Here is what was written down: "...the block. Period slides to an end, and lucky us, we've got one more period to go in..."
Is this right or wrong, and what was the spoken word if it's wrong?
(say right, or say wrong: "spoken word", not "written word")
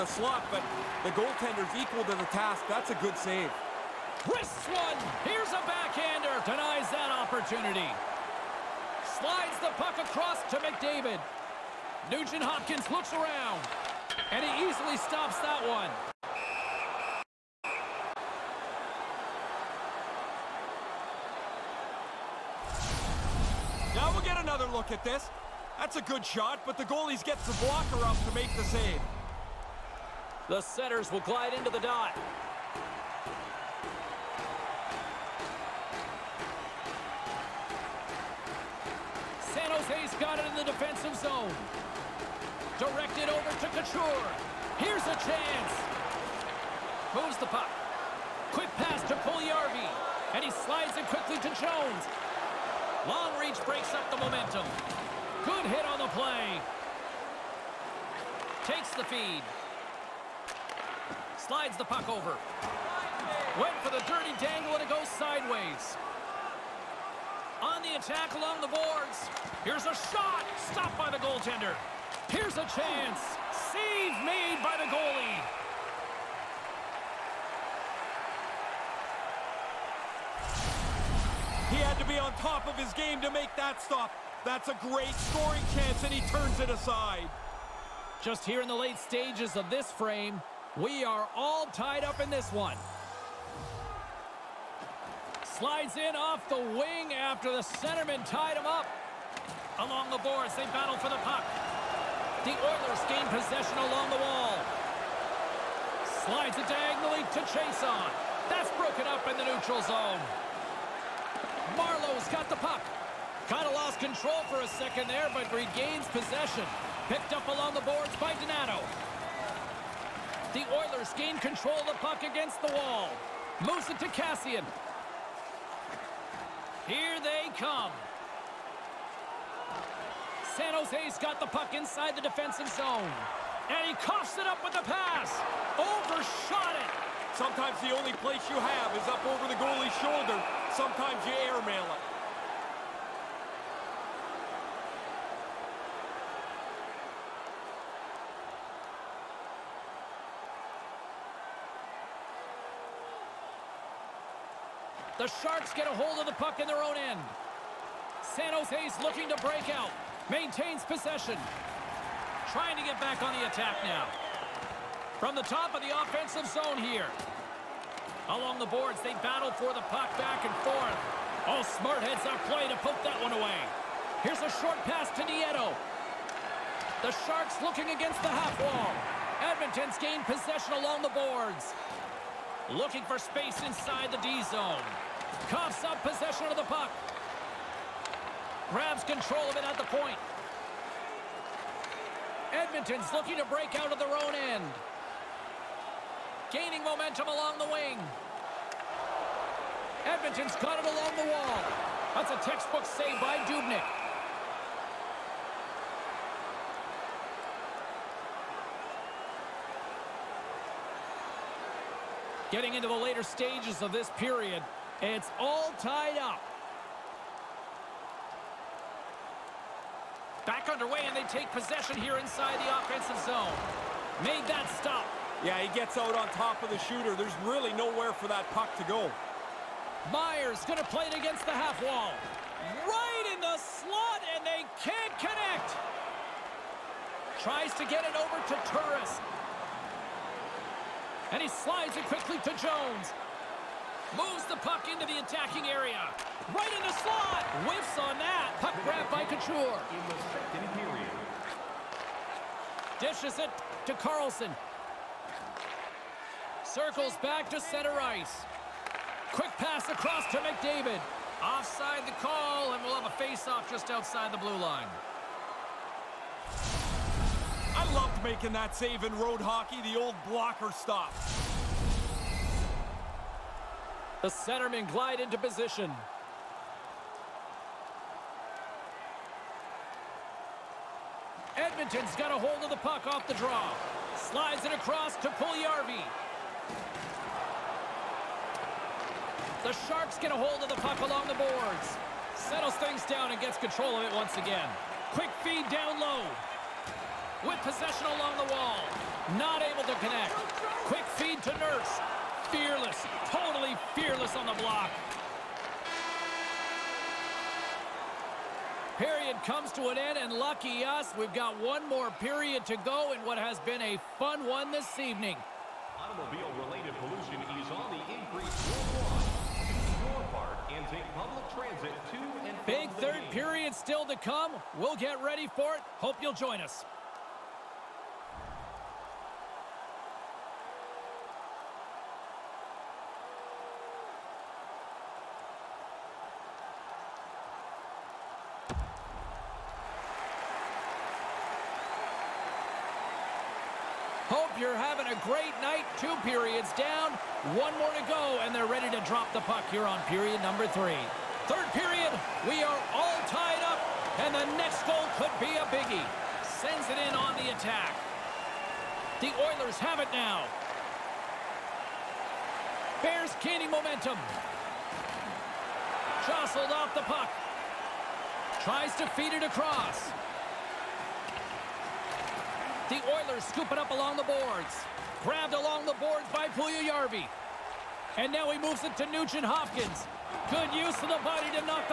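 wrong: "comes", not "slides".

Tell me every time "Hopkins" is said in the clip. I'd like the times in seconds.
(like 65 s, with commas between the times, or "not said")
12 s, 379 s.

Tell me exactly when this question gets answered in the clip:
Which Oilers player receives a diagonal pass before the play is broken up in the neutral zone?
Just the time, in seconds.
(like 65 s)
106 s.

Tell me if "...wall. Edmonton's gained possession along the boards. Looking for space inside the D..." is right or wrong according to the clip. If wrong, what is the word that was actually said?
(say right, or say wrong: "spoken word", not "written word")
right.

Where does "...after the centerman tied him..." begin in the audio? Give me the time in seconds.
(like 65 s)
97 s.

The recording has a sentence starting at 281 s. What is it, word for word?
Edmonton's got a hold of the puck off the draw.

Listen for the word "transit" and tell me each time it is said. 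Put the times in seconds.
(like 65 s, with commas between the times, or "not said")
321 s.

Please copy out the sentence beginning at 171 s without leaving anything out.
All smart heads up play to poke that one away.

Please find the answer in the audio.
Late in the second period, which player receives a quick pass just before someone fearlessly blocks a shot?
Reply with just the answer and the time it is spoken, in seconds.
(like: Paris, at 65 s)
Nurse, at 300 s.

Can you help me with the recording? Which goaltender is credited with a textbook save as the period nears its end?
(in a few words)
Dubnyk.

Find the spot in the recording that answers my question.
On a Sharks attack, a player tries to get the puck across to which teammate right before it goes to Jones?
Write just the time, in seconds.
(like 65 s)
237 s.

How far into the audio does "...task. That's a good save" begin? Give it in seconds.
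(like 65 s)
2 s.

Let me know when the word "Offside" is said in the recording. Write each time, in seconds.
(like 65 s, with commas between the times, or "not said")
261 s.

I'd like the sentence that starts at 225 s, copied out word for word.
Yeah, he gets out on top of the shooter.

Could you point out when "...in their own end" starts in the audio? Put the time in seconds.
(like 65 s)
156 s.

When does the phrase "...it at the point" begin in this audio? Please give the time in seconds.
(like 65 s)
189 s.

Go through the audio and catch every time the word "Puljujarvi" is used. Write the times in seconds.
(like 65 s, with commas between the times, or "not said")
49 s, 285 s, 376 s.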